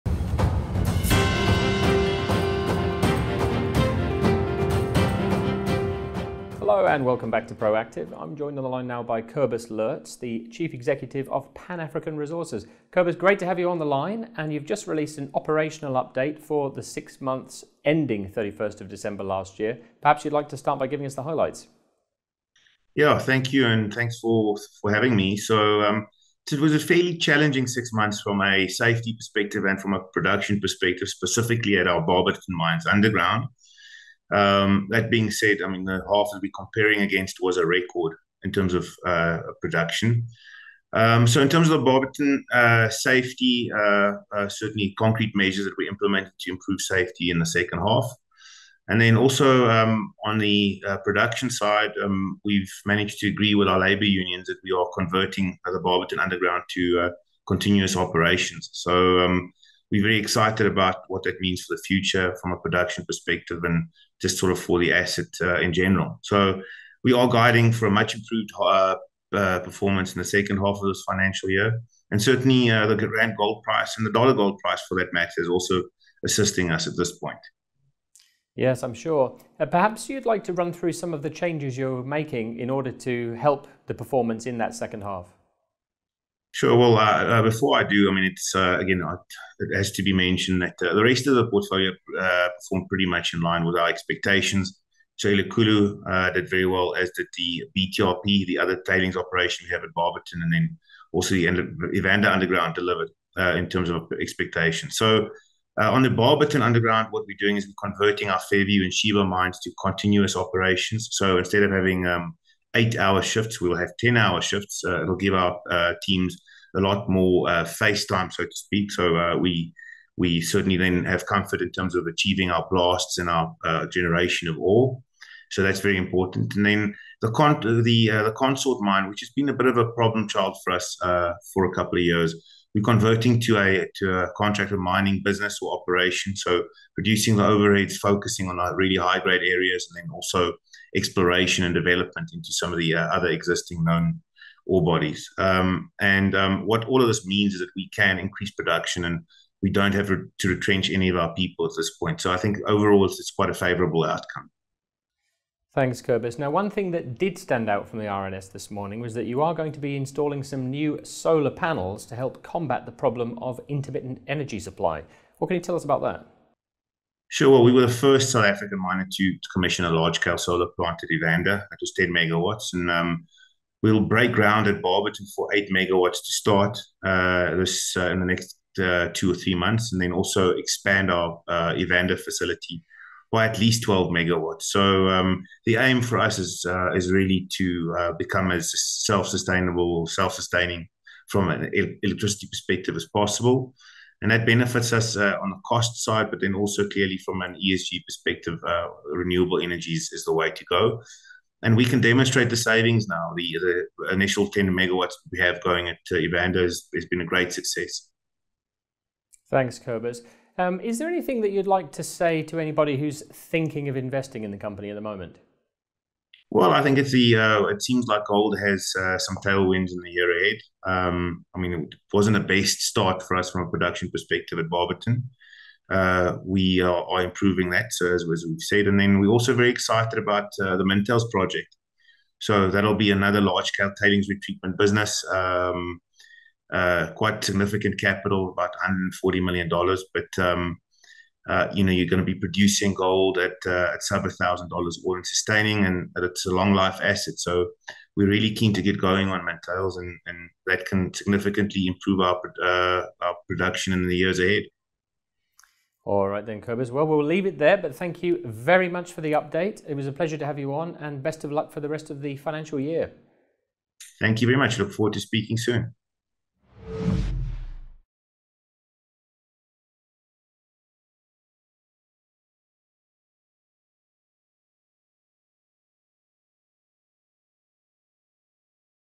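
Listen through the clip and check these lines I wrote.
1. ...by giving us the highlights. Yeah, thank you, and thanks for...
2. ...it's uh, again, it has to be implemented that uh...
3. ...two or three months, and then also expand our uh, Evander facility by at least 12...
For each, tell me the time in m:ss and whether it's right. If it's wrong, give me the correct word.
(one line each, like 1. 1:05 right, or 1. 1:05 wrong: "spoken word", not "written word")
1. 0:20 right
2. 1:28 wrong: "mentioned", not "implemented"
3. 2:59 right.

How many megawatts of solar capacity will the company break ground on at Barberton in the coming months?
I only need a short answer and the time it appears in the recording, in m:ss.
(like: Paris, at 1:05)
8 megawatts, at 2:55.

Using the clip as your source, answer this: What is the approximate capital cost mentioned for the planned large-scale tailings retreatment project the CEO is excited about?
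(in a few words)
$140 million.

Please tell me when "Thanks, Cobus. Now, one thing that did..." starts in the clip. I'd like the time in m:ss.
2:35.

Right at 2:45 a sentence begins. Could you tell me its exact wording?
What can you tell us about that?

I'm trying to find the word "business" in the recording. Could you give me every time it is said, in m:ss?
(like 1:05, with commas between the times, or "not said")
2:15, 3:54.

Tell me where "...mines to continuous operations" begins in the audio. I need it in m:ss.
1:49.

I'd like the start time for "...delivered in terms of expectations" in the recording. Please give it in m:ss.
1:42.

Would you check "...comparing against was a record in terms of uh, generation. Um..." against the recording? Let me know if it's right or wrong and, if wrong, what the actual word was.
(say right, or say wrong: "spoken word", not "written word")
wrong: "production", not "generation".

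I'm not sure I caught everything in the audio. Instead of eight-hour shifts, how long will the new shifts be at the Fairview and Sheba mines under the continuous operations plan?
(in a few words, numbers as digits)
10 hours.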